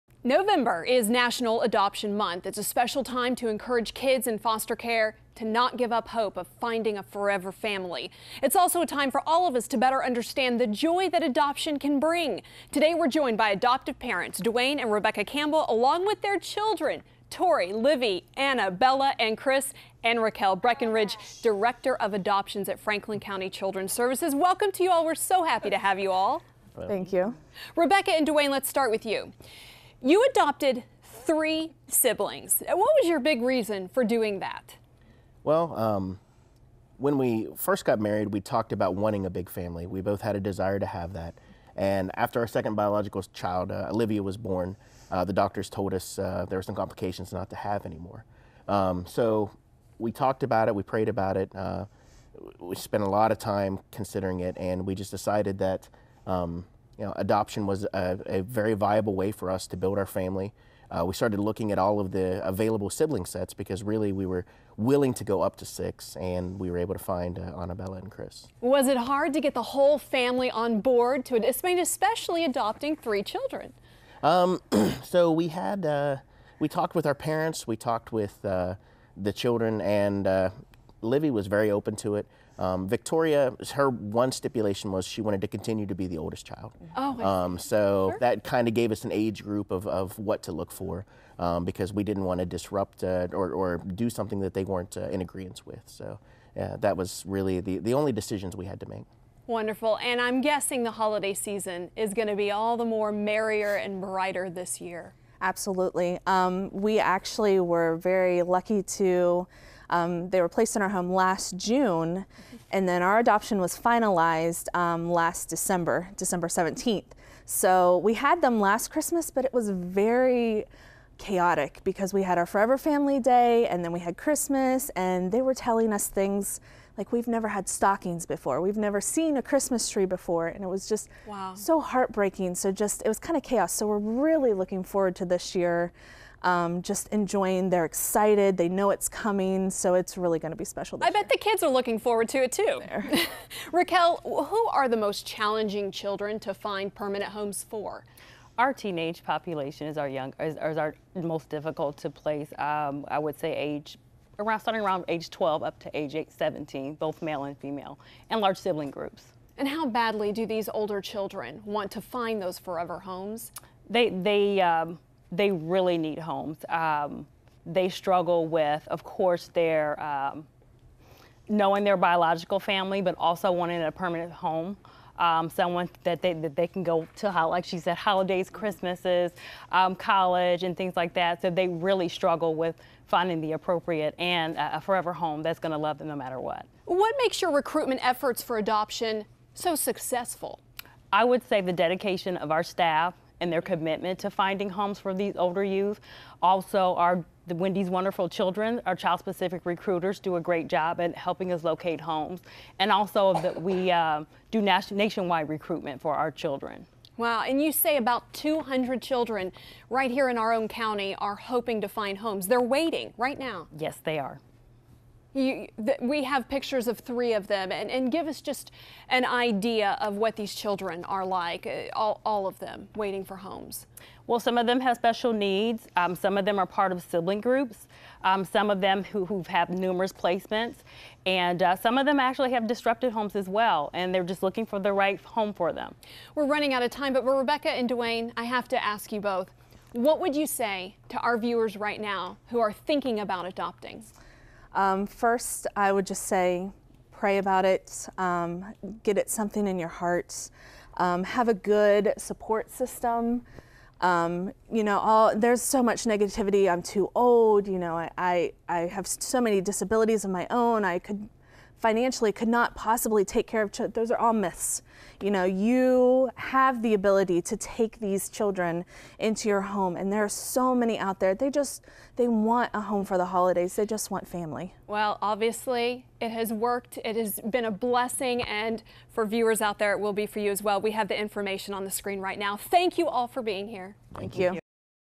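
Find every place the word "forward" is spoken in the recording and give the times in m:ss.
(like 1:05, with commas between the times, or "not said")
2:14, 2:21.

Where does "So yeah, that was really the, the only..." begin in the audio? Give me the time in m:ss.
1:35.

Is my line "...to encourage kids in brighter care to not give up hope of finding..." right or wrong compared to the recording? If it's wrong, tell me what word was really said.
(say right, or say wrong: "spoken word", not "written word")
wrong: "foster", not "brighter".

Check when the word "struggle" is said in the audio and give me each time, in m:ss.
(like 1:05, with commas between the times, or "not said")
2:47, 3:02.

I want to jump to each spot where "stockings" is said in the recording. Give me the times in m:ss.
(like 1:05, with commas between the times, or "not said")
2:07.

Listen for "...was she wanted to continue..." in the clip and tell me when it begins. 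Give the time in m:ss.
1:24.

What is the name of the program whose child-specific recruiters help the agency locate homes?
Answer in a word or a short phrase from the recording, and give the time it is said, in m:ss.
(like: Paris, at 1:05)
Wendy's Wonderful Children, at 3:17.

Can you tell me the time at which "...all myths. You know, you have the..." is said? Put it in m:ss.
4:24.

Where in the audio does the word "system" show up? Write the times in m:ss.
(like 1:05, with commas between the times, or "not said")
4:12.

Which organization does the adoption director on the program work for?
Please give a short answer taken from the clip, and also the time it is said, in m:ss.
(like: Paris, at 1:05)
Franklin County Children's Services, at 0:22.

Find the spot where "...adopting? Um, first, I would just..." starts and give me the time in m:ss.
4:03.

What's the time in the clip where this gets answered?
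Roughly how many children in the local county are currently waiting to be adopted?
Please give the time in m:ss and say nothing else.
3:28.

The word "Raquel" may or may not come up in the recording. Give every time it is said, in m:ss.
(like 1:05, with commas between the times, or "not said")
0:20, 2:23.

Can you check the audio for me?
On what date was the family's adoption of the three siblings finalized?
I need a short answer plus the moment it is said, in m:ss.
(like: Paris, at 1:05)
December 17th, at 1:56.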